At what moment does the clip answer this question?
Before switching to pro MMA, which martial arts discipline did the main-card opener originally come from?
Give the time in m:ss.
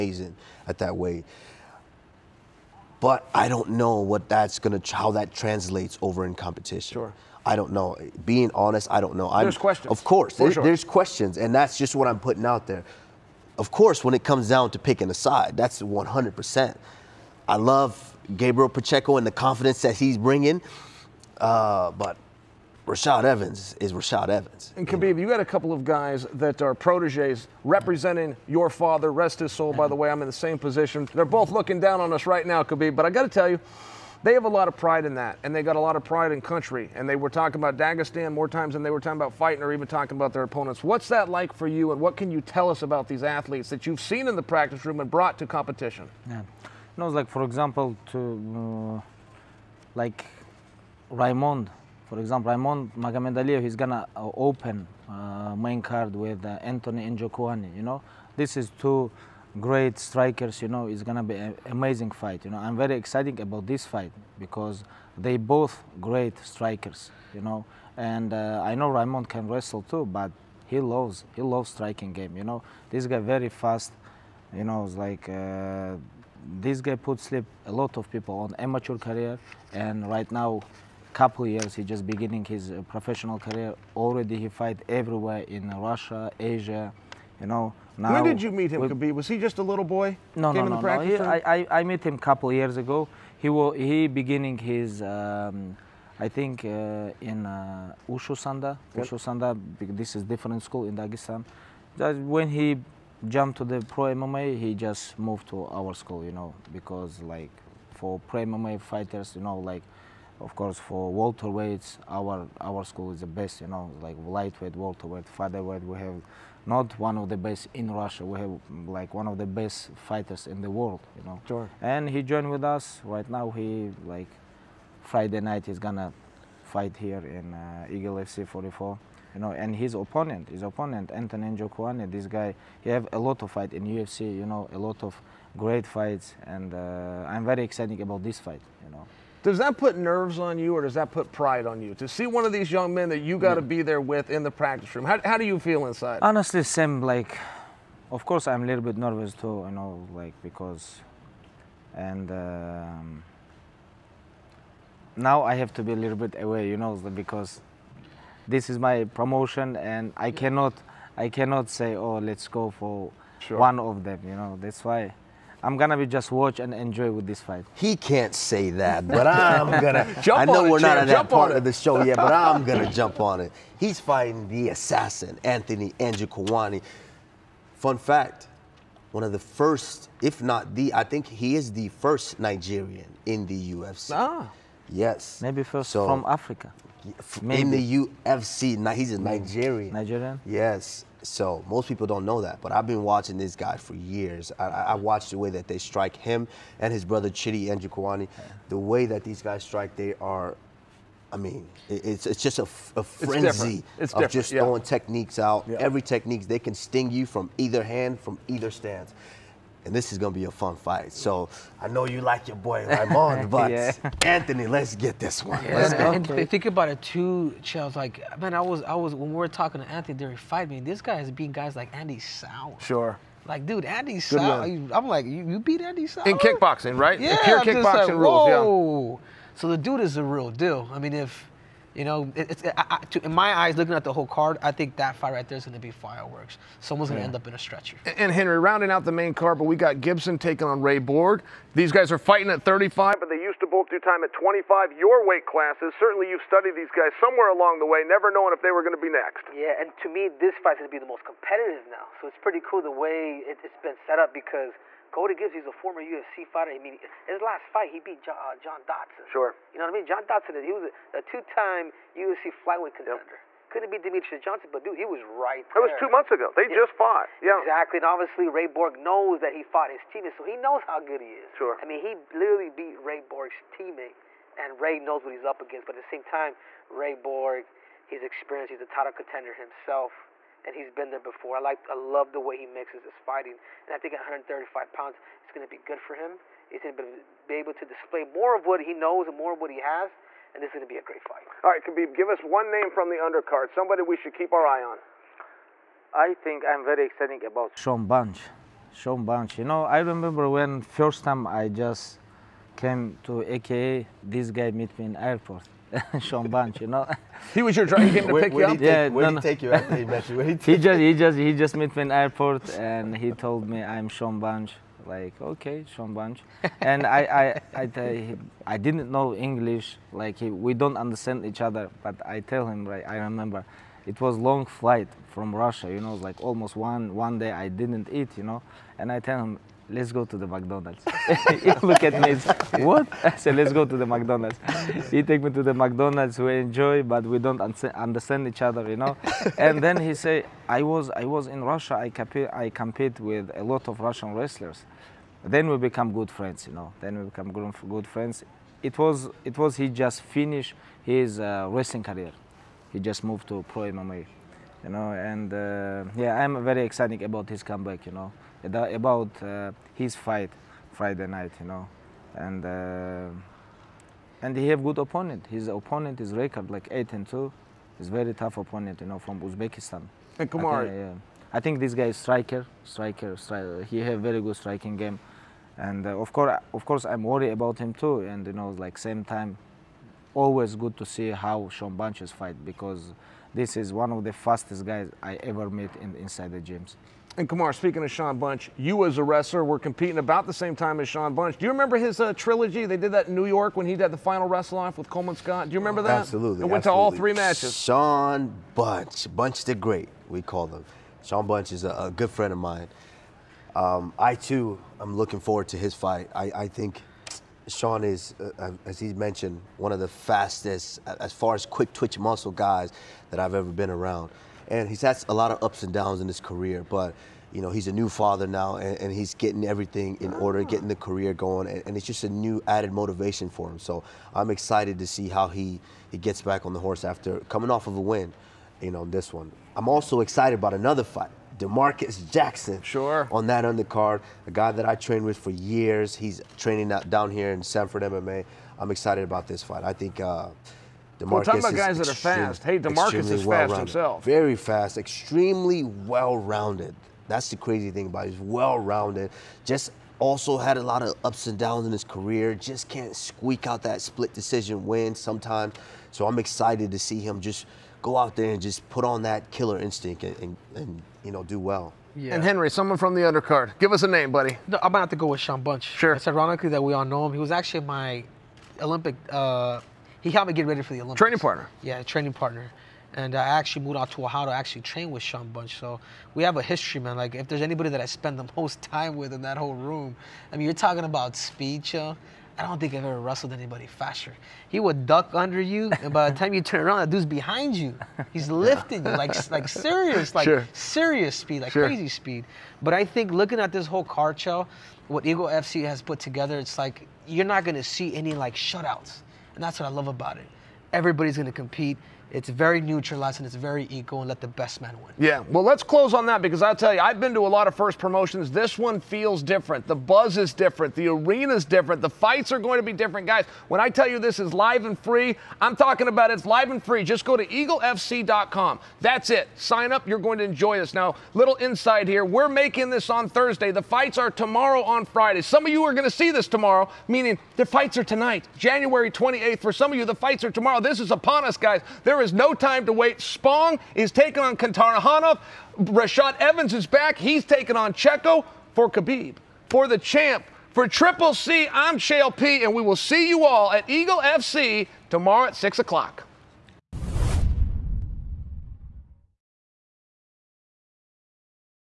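1:38.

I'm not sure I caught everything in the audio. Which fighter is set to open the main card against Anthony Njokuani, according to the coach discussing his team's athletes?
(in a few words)
Raymond Magomedaliev.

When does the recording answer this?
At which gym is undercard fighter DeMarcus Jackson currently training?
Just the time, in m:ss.
7:17.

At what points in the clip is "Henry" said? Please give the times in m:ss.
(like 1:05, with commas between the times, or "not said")
3:58, 7:42.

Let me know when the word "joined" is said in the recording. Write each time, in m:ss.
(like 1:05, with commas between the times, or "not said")
2:02.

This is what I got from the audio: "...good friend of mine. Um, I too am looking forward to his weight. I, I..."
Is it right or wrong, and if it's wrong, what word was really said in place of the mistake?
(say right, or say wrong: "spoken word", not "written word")
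wrong: "fight", not "weight".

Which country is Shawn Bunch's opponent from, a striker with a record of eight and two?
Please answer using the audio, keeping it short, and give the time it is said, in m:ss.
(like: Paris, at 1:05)
Uzbekistan, at 6:09.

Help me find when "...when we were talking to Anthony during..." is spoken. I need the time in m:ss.
3:39.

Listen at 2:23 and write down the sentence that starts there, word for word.
be there with in the practice room?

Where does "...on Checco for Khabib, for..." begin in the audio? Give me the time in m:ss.
8:57.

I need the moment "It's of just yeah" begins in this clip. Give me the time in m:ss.
3:23.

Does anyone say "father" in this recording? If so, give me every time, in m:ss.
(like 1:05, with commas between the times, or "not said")
0:28, 6:58.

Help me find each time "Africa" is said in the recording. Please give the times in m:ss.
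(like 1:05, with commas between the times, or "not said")
3:06.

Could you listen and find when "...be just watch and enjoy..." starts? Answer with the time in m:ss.
2:45.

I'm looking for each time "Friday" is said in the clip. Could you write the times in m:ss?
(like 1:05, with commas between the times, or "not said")
2:05, 6:00, 8:45.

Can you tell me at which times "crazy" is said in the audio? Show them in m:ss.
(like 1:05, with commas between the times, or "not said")
7:27, 8:11.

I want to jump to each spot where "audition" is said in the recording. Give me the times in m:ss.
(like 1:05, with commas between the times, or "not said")
not said.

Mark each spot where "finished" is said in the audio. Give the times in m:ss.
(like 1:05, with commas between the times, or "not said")
5:50.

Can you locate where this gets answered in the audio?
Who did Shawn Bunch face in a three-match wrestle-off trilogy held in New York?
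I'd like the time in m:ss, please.
6:35.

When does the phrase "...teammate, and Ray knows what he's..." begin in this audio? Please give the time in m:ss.
4:33.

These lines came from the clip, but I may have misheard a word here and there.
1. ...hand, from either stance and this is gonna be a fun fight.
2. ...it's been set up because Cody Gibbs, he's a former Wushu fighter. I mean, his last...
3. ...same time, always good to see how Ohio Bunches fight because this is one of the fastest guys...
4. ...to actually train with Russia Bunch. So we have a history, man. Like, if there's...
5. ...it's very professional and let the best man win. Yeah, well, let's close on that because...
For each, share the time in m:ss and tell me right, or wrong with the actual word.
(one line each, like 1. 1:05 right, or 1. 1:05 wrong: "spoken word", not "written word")
1. 3:27 right
2. 4:13 wrong: "UFC", not "Wushu"
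3. 6:18 wrong: "Shawn", not "Ohio"
4. 7:54 wrong: "Shawn", not "Russia"
5. 8:23 wrong: "equal", not "professional".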